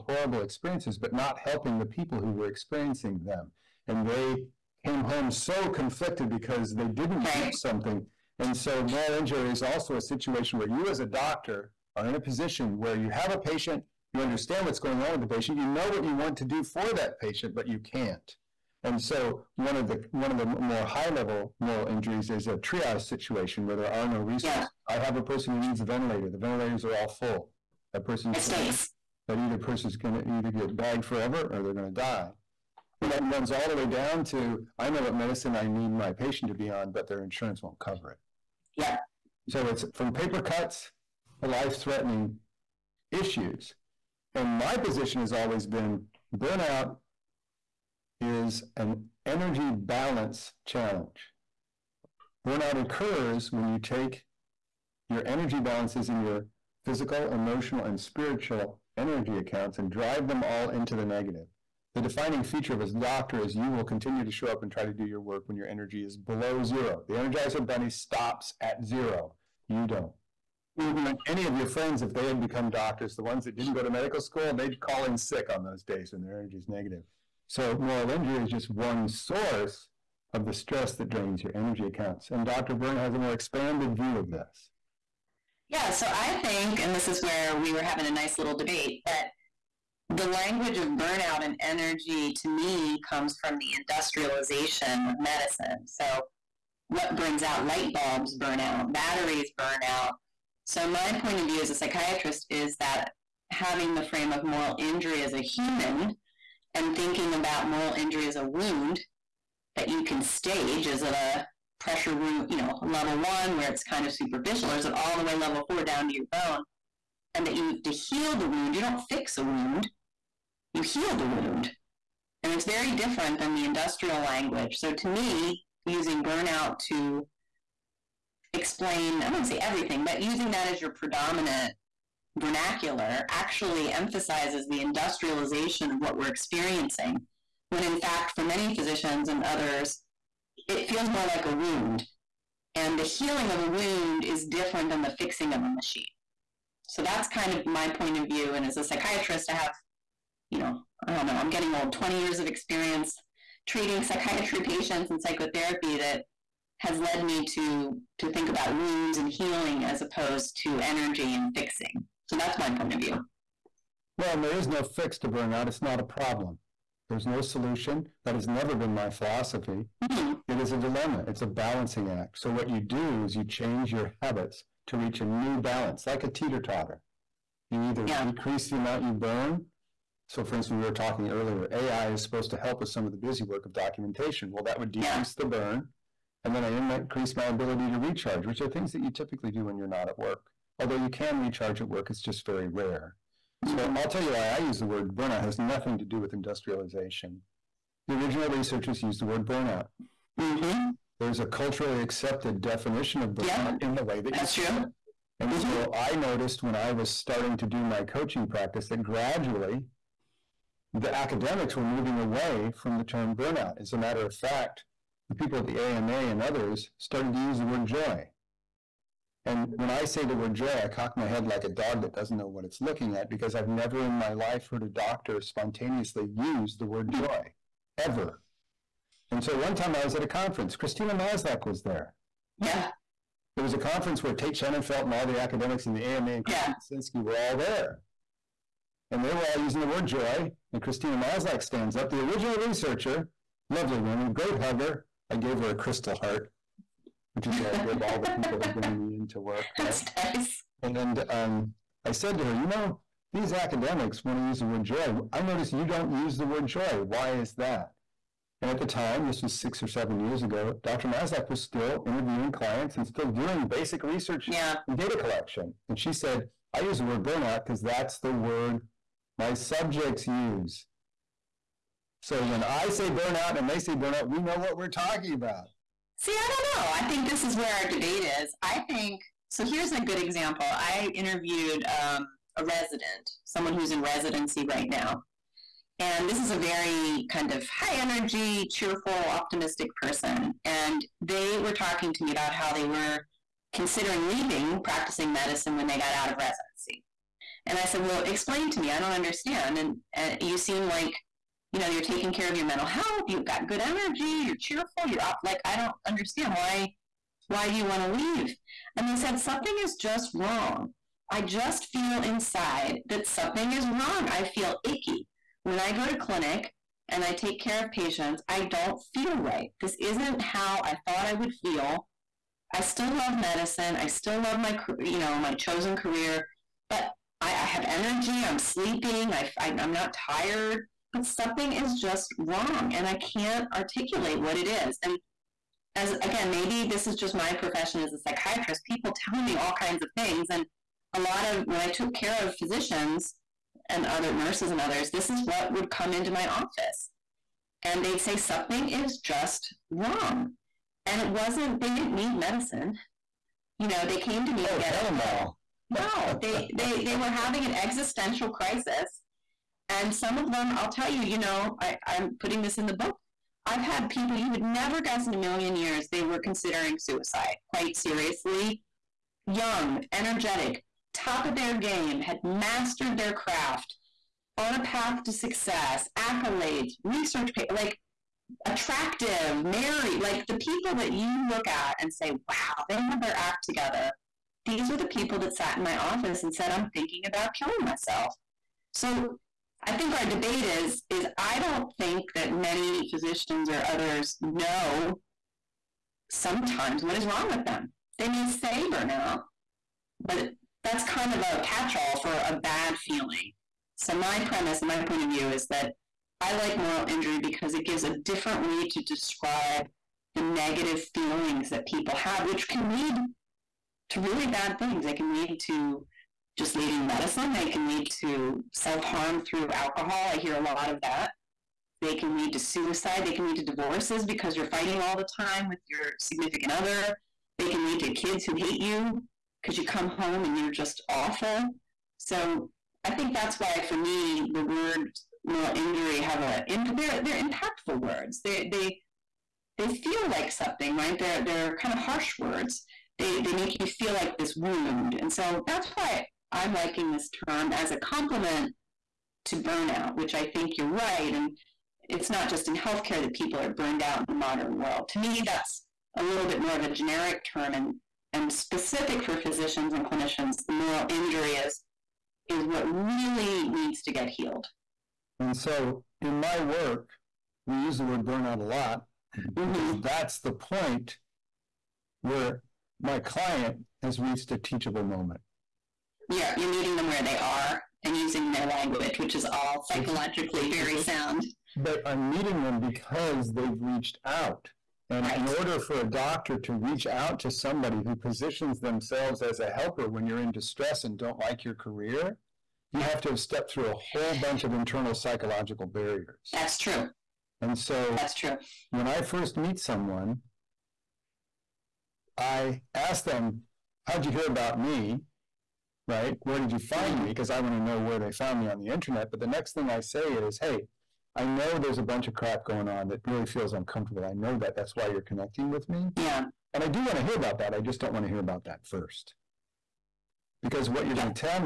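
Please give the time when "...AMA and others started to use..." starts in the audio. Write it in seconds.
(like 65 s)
215 s.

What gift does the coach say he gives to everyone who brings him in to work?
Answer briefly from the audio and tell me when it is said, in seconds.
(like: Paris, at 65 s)
A crystal heart, at 245 s.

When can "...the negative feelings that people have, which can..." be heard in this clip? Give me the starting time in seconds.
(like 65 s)
410 s.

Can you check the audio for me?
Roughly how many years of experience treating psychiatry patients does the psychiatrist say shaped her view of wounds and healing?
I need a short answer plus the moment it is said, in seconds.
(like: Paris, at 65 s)
20, at 151 s.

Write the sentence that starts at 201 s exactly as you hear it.
There's a culturally accepted definition of burnout yeah, in the way that that's true.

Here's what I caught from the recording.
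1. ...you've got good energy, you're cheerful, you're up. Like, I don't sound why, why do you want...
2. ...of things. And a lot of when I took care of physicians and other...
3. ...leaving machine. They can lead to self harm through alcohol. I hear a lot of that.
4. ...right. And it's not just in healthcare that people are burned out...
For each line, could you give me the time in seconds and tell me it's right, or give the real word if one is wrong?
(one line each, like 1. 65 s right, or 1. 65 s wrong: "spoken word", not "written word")
1. 303 s wrong: "understand", not "sound"
2. 340 s right
3. 416 s wrong: "medicine", not "machine"
4. 450 s right.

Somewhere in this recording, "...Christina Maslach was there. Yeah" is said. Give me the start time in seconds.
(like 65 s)
230 s.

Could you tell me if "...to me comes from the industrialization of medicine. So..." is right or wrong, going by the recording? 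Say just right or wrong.
right.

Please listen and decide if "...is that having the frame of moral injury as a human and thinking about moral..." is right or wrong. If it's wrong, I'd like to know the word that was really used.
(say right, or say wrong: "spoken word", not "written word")
right.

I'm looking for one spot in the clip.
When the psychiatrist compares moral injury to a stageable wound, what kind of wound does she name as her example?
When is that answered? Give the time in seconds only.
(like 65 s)
111 s.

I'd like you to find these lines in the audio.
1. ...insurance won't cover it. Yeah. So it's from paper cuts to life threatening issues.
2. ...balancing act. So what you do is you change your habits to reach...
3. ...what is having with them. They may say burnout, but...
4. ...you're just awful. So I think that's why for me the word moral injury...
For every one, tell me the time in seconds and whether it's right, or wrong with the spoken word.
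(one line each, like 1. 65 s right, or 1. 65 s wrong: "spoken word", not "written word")
1. 37 s right
2. 171 s right
3. 397 s wrong: "wrong", not "having"
4. 430 s right.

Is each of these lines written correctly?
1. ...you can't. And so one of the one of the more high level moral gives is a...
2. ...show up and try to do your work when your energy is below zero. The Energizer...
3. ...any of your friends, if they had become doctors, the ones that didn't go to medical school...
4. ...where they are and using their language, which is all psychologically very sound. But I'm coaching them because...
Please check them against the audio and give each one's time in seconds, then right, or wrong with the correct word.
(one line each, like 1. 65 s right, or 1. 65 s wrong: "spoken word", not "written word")
1. 17 s wrong: "injuries", not "gives"
2. 64 s right
3. 71 s right
4. 477 s wrong: "meeting", not "coaching".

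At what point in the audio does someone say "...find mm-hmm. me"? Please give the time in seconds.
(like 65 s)
506 s.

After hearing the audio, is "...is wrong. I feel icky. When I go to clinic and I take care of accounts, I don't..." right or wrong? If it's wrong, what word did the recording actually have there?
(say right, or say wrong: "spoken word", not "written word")
wrong: "patients", not "accounts".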